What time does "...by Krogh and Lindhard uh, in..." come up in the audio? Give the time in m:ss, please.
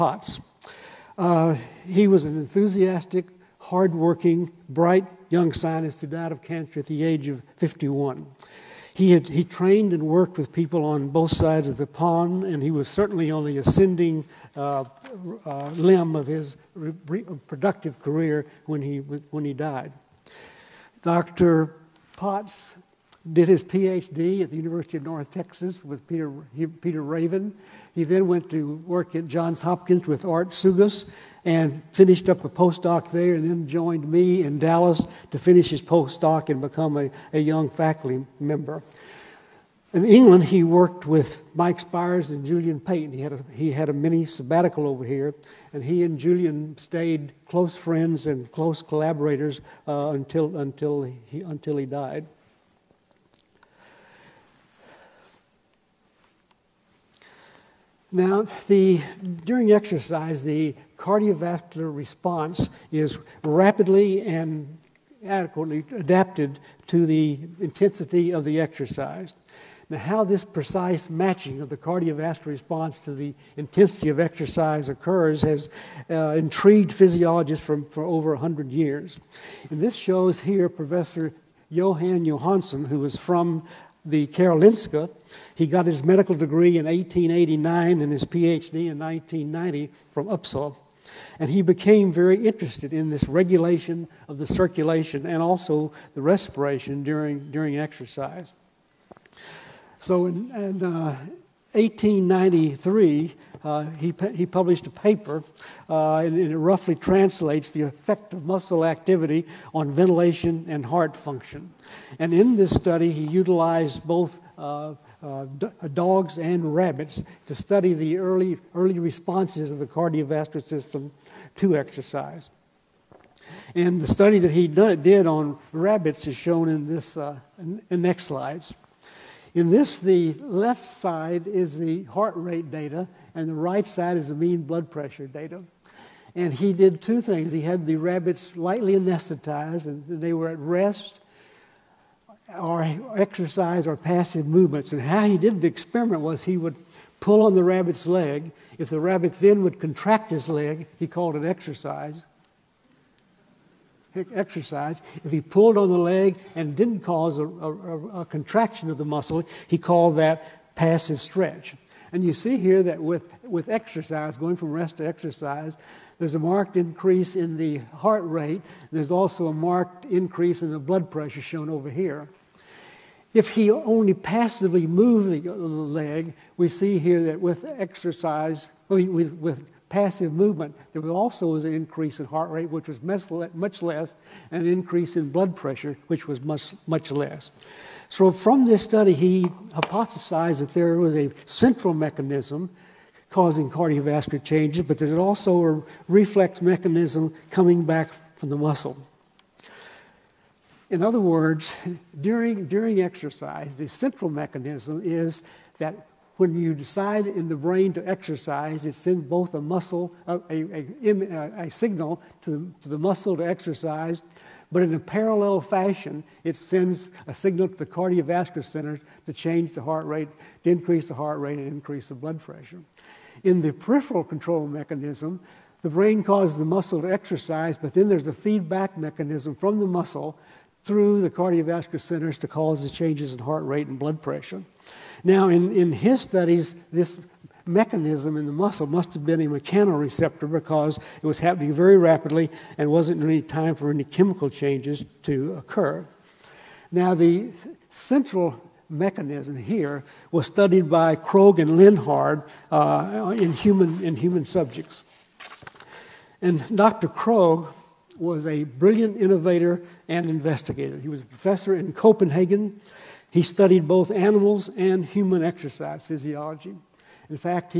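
4:10.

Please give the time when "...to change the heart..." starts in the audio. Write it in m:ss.
3:39.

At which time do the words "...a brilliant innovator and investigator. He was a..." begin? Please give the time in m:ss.
4:18.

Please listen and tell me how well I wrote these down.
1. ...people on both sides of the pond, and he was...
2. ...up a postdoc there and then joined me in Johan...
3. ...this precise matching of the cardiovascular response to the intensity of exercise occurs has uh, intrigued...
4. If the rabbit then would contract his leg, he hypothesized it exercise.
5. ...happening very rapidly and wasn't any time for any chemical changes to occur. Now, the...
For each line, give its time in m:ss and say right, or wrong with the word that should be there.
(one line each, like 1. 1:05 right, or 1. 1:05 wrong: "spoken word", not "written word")
1. 0:10 right
2. 0:32 wrong: "Dallas", not "Johan"
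3. 1:10 right
4. 2:28 wrong: "called", not "hypothesized"
5. 4:01 right.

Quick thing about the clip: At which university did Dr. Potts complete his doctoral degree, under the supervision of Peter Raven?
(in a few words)
University of North Texas.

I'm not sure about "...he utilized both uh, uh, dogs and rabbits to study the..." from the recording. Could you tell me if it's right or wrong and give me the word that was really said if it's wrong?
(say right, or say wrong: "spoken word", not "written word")
right.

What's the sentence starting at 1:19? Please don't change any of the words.
And this shows here Professor Johan Johansson, who was from the Karolinska.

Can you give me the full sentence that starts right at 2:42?
And you see here that with, with exercise, going from rest to exercise, there's a marked increase in the heart rate.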